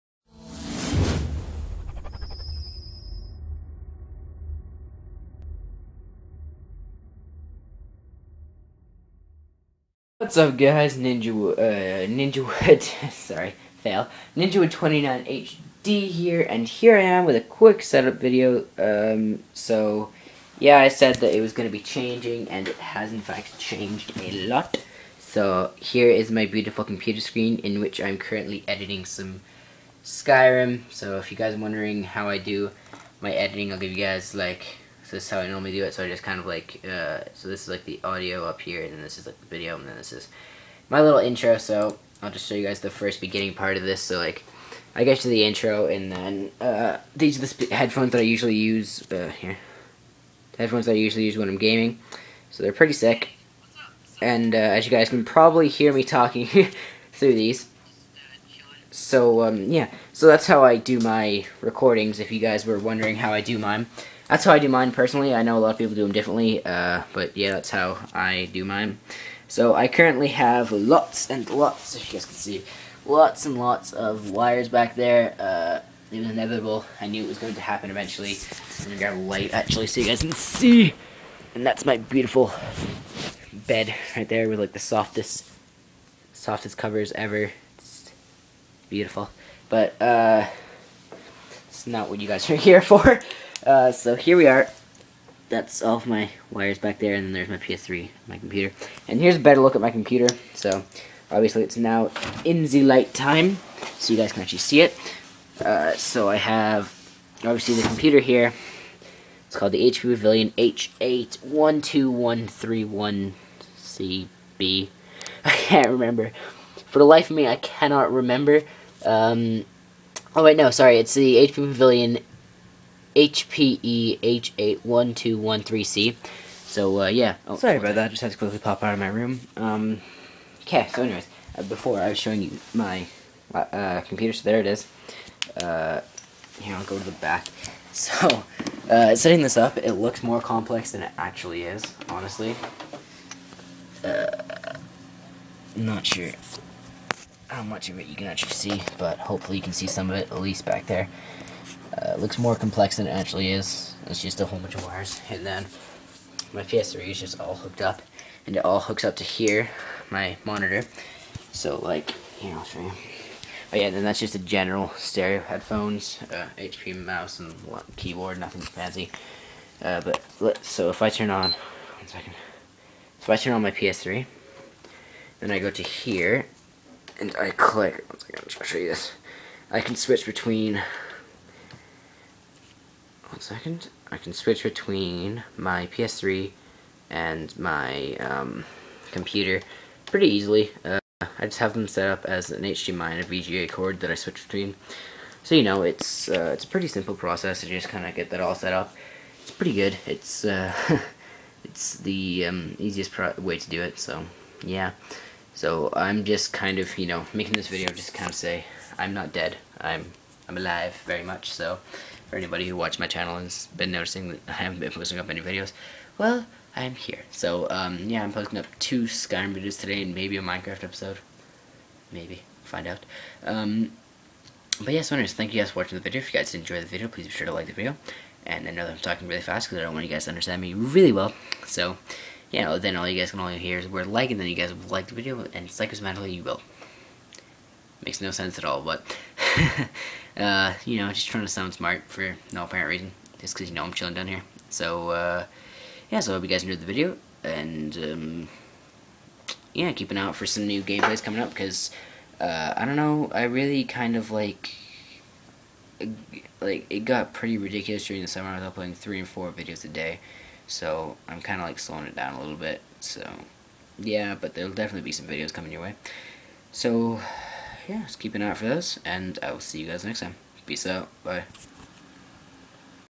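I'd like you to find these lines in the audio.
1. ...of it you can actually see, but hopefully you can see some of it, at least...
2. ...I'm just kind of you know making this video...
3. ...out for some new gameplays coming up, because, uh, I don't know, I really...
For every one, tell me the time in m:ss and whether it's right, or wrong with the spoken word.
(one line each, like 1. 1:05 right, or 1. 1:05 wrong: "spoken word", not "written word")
1. 2:27 right
2. 3:25 right
3. 4:10 right.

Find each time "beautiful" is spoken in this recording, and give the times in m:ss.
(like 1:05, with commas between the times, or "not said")
0:26, 1:21, 1:28.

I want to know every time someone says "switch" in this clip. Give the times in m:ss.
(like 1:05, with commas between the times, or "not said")
2:59, 3:04, 3:14.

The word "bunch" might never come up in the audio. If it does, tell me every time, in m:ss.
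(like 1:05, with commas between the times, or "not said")
2:34.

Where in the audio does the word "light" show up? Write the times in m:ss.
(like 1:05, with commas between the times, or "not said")
1:19, 1:42.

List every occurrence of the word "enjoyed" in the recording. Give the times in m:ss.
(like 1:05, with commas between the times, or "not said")
3:46, 4:06.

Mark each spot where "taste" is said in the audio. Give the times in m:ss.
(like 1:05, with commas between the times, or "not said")
not said.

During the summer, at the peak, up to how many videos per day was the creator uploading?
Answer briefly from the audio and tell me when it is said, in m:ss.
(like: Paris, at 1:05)
4, at 4:19.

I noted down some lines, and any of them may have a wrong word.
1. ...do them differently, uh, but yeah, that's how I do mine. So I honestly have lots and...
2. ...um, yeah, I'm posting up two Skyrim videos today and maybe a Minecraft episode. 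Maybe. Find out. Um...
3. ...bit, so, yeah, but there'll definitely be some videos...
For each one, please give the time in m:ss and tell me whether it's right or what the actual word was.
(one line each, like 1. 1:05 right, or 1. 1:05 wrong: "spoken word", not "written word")
1. 1:05 wrong: "currently", not "honestly"
2. 3:37 right
3. 4:22 right.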